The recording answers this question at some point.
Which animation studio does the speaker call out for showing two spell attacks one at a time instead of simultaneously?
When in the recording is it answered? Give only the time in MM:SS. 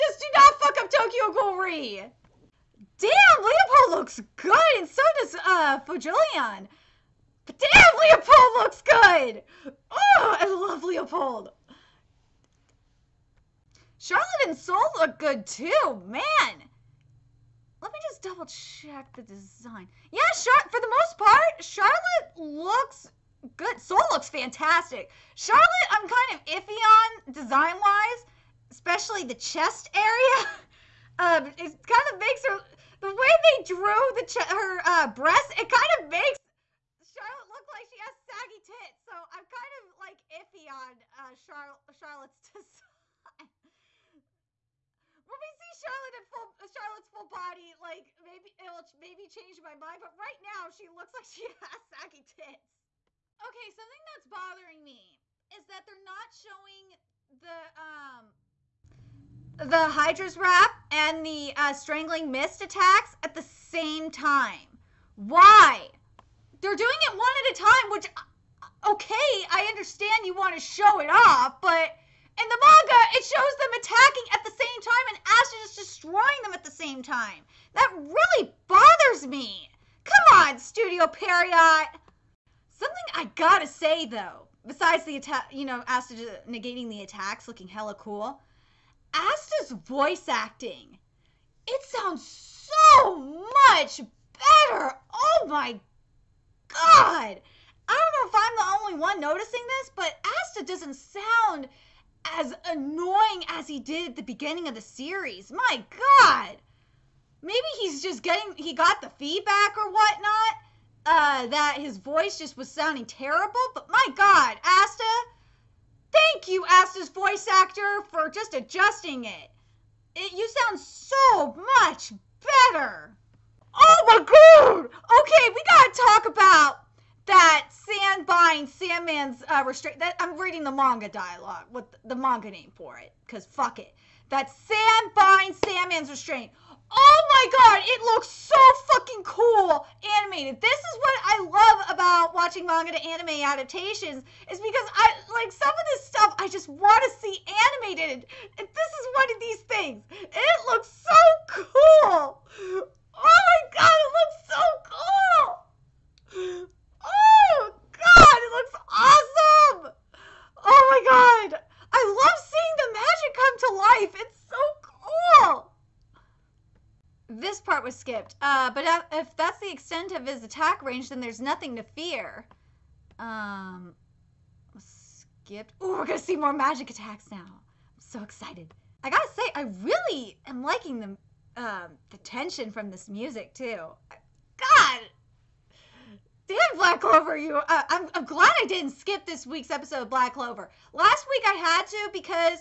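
01:20.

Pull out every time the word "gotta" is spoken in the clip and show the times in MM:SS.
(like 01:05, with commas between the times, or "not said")
01:23, 02:59.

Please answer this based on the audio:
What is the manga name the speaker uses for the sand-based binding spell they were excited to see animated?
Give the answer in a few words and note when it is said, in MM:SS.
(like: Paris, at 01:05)
Sandman's restraint, at 02:15.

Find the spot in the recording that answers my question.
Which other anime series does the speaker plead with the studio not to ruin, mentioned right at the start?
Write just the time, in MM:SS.
00:00.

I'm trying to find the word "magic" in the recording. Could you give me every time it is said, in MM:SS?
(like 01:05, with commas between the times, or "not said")
02:42, 02:56.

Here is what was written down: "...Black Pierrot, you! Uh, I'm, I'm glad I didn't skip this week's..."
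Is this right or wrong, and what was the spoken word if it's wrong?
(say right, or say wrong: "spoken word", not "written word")
wrong: "Clover", not "Pierrot".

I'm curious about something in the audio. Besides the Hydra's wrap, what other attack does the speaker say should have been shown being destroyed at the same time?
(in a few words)
strangling mist.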